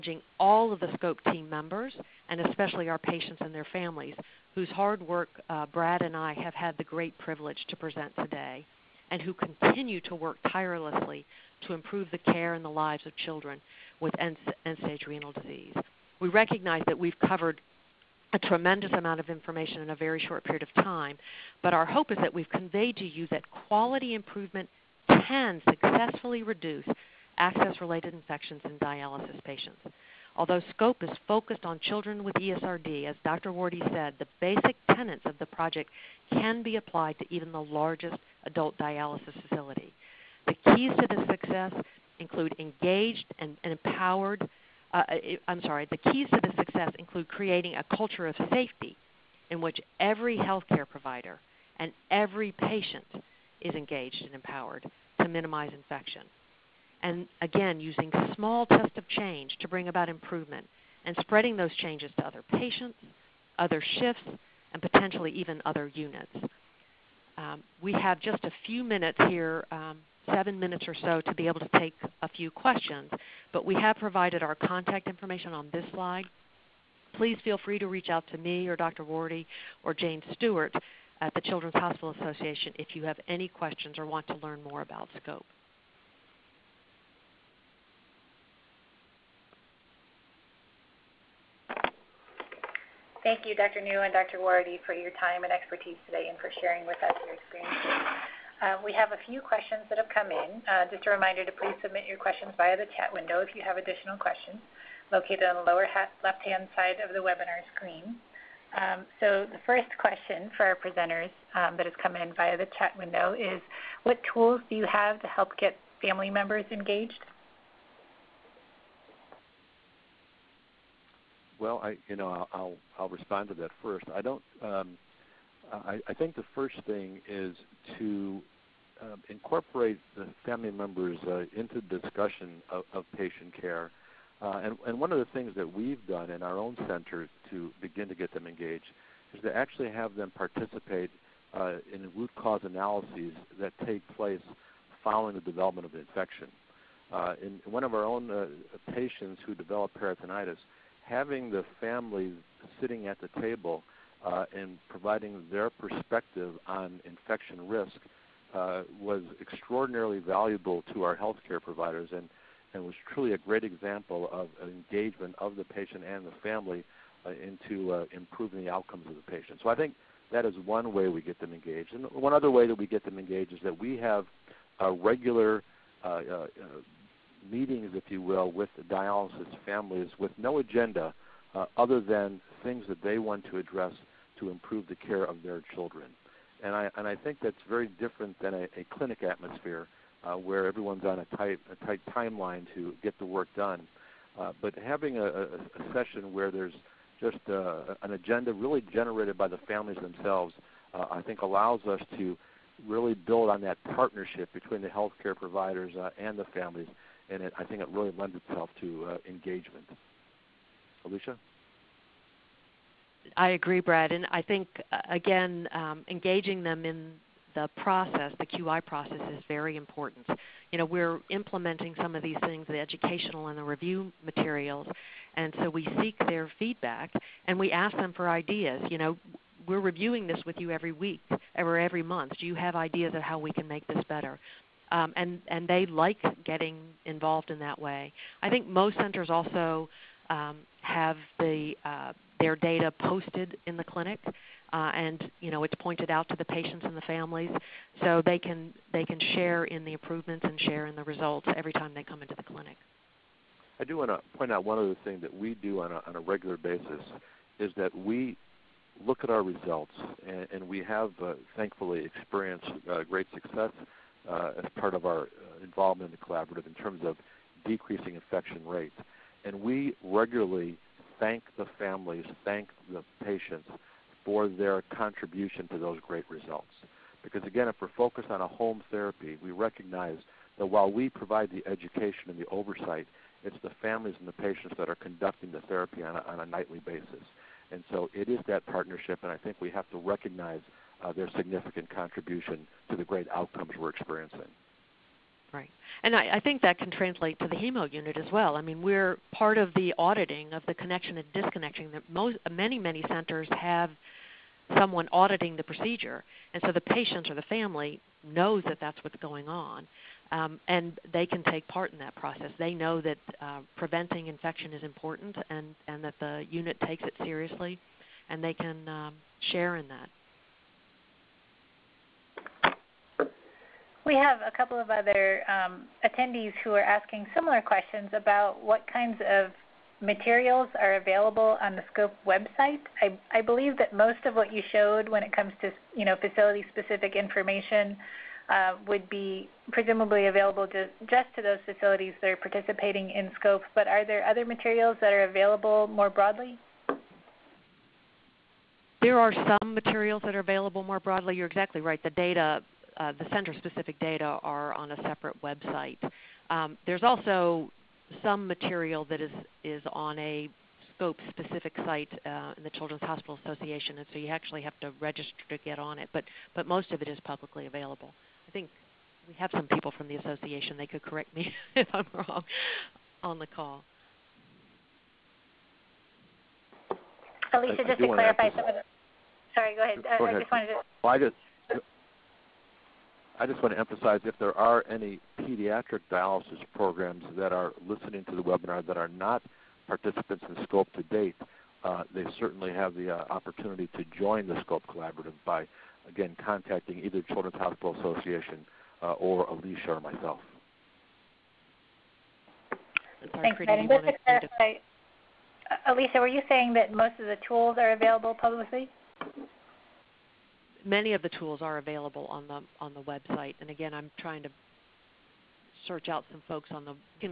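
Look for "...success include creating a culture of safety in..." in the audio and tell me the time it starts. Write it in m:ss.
0:46.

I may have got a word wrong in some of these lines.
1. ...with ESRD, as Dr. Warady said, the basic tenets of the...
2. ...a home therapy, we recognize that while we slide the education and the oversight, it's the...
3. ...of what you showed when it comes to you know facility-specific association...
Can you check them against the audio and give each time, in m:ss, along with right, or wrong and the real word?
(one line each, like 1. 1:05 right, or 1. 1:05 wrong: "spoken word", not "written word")
1. 0:32 right
2. 4:38 wrong: "provide", not "slide"
3. 5:34 wrong: "information", not "association".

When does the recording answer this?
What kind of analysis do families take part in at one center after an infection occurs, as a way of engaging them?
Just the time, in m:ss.
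2:22.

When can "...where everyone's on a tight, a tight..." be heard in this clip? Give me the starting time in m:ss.
3:10.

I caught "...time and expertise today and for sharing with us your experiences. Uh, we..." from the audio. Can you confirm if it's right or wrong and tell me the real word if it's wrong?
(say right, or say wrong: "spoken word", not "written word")
right.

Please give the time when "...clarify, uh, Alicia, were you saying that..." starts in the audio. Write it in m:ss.
6:44.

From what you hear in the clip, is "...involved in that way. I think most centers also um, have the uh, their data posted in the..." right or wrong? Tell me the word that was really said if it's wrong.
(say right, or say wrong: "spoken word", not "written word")
right.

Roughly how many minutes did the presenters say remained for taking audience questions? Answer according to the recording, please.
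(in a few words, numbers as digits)
7.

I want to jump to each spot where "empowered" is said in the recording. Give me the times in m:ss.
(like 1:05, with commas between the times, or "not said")
0:43, 0:54.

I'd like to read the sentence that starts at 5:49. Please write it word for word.
There are some materials that are available more broadly.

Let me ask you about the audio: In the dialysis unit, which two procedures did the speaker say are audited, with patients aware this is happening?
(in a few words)
connection and disconnection.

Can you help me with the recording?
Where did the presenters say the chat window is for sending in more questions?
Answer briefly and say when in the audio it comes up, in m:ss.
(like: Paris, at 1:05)
lower left-hand side, at 1:45.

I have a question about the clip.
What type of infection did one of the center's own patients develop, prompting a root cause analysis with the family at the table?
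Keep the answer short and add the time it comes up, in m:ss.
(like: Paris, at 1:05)
peritonitis, at 2:29.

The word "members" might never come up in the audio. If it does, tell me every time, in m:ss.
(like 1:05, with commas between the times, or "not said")
0:01, 1:56, 2:10.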